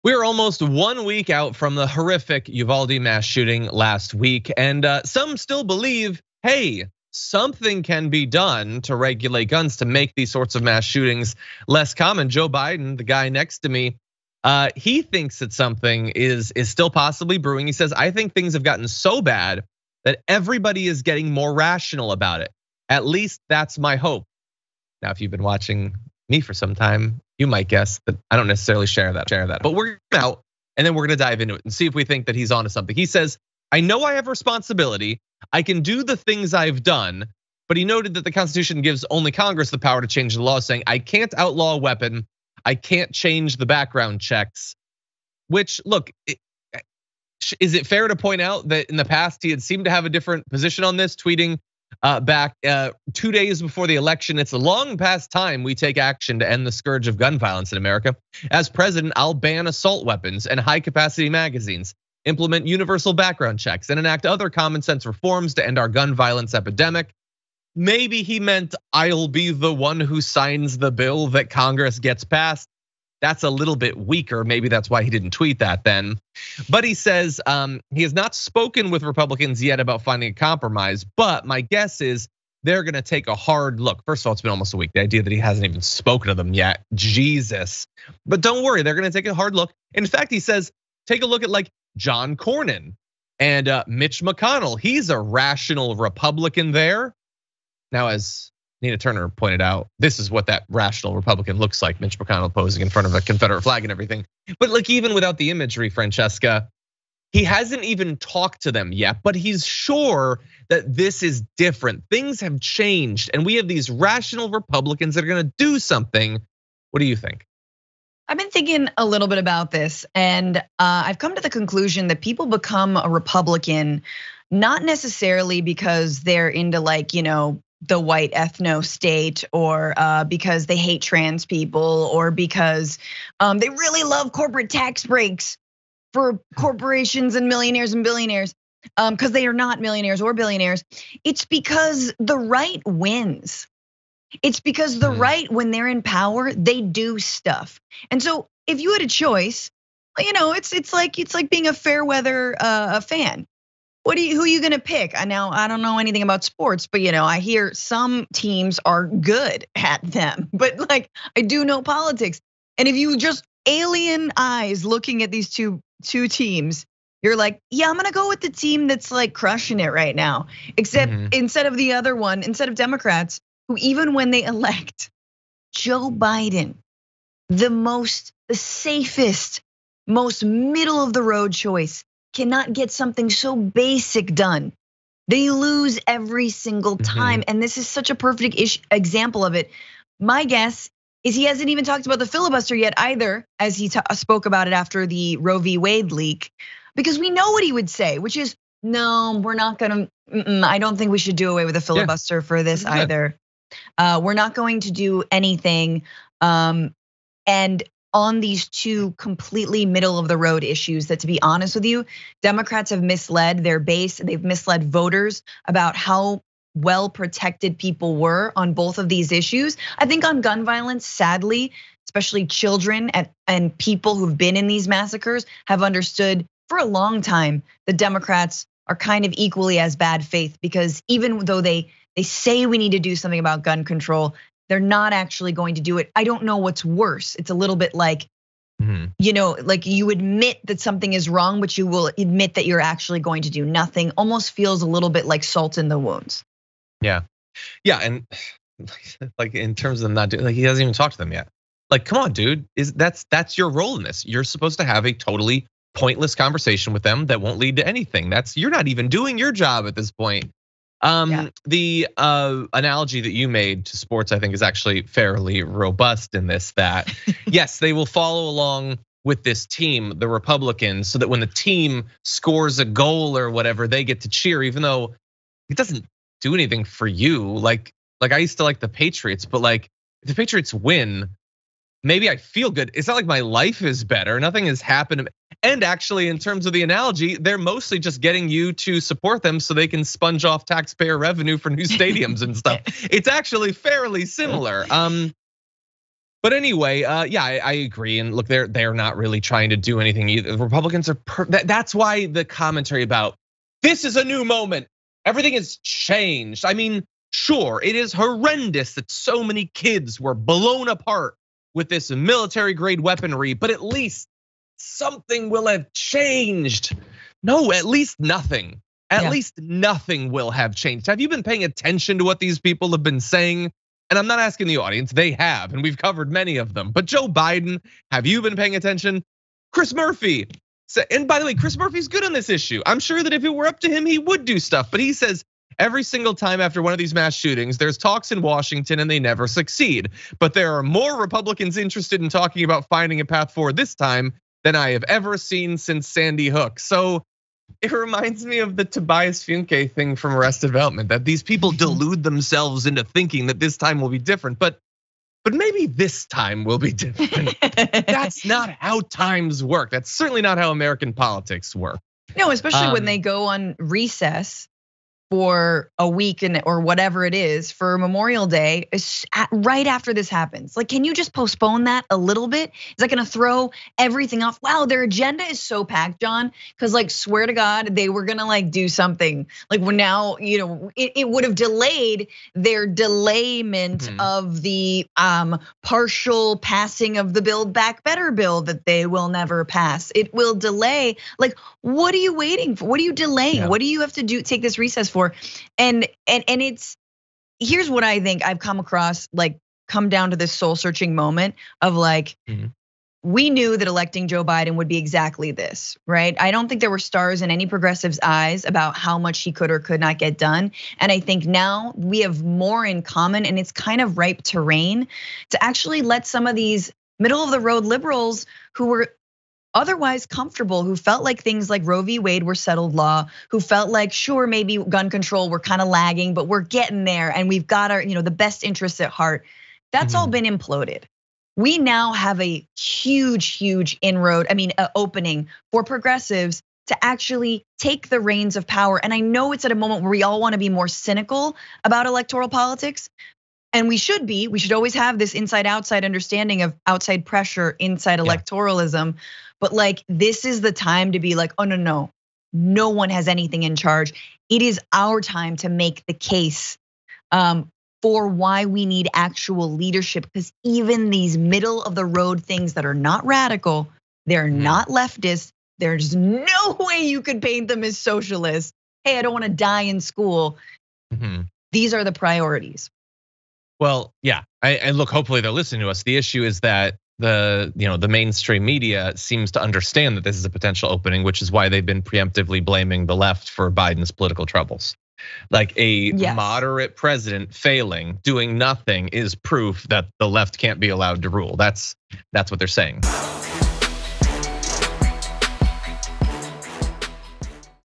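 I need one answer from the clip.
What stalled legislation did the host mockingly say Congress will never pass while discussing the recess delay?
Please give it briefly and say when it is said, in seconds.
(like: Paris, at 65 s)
Build Back Better, at 387 s.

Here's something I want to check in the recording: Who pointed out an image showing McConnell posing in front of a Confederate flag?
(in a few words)
Nina Turner.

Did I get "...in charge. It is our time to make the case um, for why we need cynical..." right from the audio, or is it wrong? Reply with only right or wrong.
wrong.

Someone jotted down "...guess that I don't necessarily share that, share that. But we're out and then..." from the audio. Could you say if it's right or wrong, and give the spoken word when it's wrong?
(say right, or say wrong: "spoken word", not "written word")
right.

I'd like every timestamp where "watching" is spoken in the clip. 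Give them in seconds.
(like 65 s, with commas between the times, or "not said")
25 s.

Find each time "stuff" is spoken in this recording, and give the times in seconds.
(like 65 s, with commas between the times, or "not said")
147 s, 292 s, 334 s.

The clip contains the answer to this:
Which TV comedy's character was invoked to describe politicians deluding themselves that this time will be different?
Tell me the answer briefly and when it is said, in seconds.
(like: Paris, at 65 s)
Arrested Development, at 350 s.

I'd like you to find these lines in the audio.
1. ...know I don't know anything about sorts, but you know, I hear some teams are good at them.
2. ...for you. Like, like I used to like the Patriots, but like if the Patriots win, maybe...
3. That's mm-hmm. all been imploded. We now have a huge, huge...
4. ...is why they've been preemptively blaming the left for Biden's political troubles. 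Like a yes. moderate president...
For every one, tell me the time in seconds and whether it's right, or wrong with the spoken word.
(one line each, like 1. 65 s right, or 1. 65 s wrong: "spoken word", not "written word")
1. 155 s wrong: "sports", not "sorts"
2. 276 s right
3. 429 s right
4. 481 s right.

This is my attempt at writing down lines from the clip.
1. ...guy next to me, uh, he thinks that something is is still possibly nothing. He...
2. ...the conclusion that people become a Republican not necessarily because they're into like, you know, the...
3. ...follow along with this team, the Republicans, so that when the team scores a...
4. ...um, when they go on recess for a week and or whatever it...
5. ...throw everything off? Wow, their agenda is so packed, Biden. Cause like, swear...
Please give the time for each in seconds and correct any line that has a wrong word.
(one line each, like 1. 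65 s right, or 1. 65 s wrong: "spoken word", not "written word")
1. 13 s wrong: "brewing", not "nothing"
2. 121 s right
3. 268 s right
4. 362 s right
5. 373 s wrong: "John", not "Biden".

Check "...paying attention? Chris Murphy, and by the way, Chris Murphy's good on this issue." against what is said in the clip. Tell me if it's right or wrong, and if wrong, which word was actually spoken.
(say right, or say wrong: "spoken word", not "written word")
right.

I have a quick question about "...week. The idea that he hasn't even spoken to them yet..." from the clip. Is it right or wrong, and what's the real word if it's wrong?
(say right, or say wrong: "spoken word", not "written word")
right.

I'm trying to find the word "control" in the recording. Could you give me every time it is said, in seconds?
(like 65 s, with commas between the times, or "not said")
233 s, 425 s.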